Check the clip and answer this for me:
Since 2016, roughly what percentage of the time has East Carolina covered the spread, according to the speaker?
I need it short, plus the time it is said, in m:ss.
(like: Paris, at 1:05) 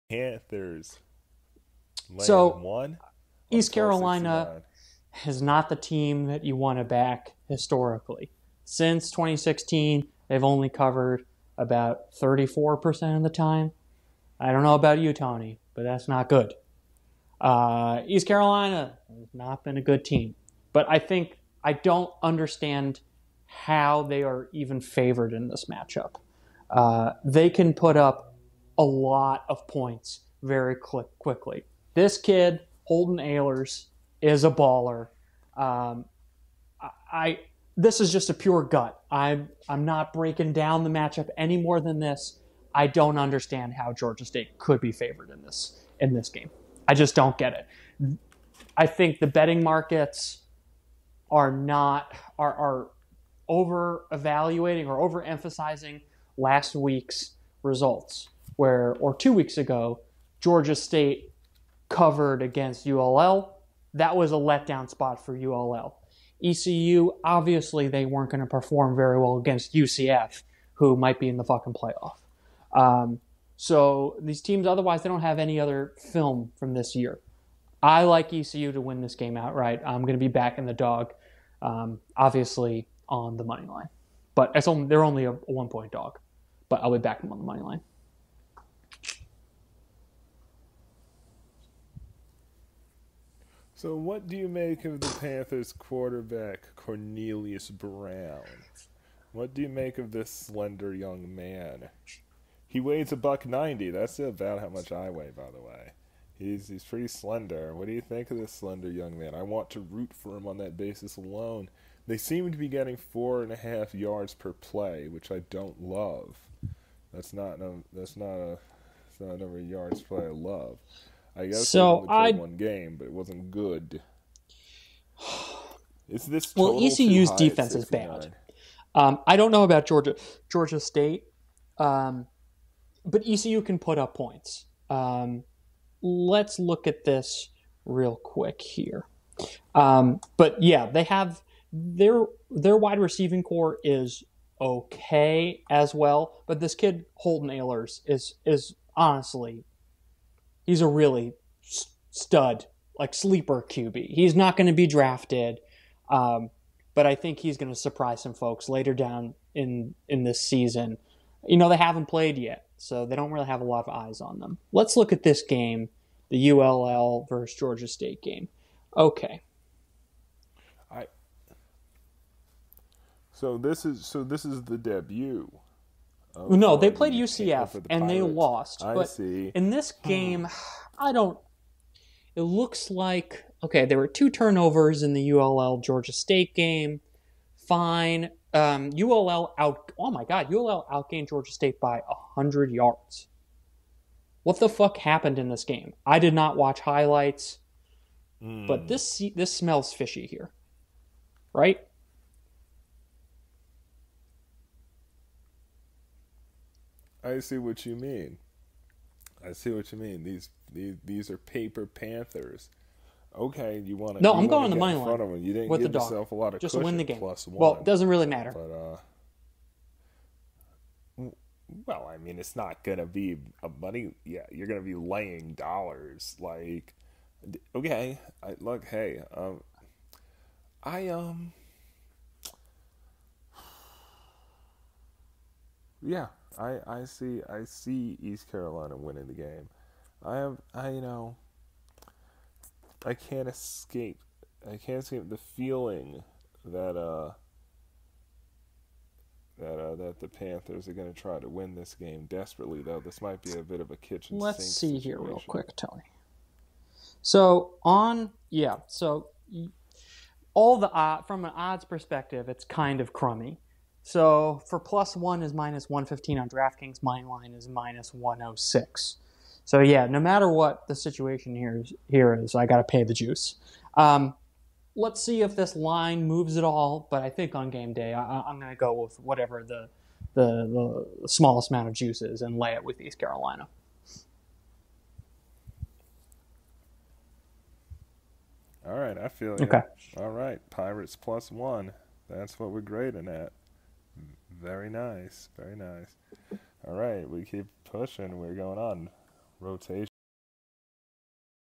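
34%, at 0:12.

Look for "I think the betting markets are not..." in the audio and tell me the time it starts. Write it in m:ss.
0:48.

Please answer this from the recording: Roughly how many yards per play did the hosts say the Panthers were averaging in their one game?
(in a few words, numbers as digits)
4.5.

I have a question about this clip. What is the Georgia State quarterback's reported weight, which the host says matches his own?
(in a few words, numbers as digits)
190 pounds.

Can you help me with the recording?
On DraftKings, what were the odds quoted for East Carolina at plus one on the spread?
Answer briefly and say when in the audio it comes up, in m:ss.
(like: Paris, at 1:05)
-115, at 4:25.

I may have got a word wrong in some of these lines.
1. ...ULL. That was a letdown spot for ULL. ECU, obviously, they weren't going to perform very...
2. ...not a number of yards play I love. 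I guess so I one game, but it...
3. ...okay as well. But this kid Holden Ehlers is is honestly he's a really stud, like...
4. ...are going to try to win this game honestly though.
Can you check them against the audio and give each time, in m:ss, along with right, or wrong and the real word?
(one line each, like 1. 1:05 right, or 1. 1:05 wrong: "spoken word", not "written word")
1. 1:02 right
2. 1:59 right
3. 2:24 right
4. 4:10 wrong: "desperately", not "honestly".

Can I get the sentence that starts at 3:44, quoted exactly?
Yeah, you're gonna be laying dollars.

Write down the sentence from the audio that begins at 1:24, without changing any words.
But it's only, they're only a one point dog, but I'll be back on the money line.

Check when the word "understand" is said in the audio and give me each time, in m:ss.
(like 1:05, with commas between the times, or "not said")
0:22, 0:43.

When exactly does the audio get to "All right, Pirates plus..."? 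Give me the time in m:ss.
4:50.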